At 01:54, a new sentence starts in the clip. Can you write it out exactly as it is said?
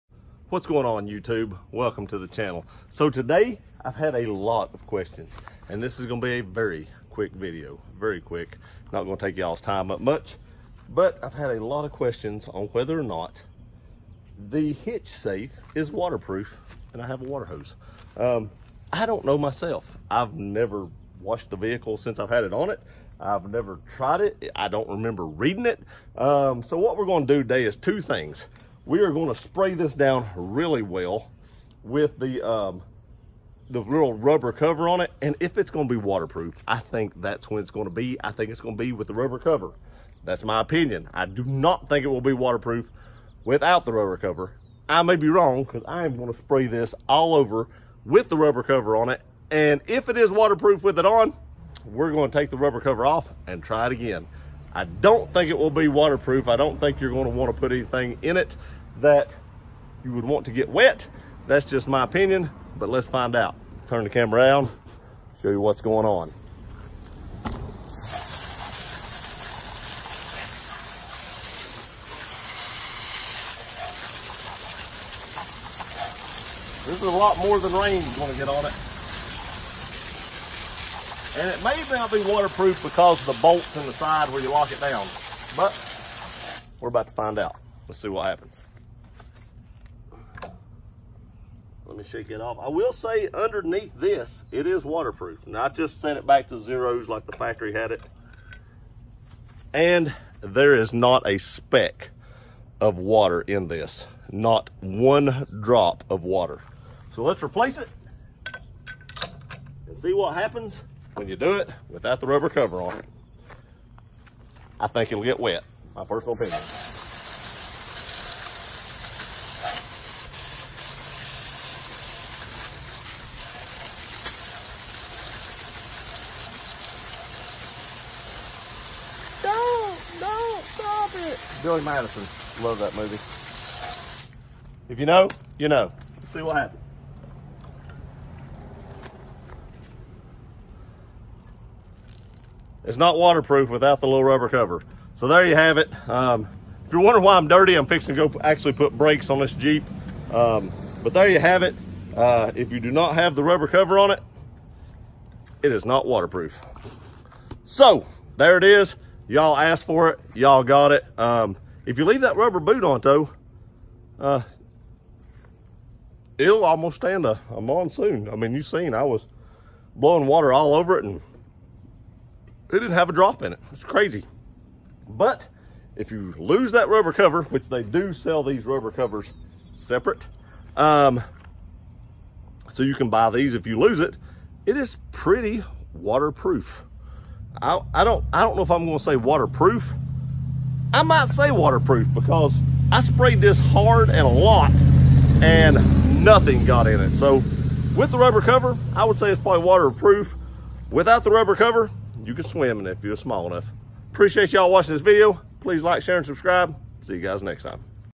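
I think it'll get wet, my personal opinion.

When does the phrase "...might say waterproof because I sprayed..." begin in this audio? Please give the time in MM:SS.
03:11.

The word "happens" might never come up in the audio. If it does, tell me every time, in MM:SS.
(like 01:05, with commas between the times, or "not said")
01:28, 01:50, 02:16.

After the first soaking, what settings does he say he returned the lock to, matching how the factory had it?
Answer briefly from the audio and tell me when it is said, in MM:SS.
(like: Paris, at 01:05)
zeros, at 01:36.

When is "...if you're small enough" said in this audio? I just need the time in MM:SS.
03:22.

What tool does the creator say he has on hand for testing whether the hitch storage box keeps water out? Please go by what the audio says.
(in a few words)
water hose.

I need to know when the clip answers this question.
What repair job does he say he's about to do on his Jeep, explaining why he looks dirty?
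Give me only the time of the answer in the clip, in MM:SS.
02:28.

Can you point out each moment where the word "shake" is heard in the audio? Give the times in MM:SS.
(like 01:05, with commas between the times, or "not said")
01:32.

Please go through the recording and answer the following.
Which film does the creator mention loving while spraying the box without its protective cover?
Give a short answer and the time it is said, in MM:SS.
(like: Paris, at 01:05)
Billy Madison, at 02:11.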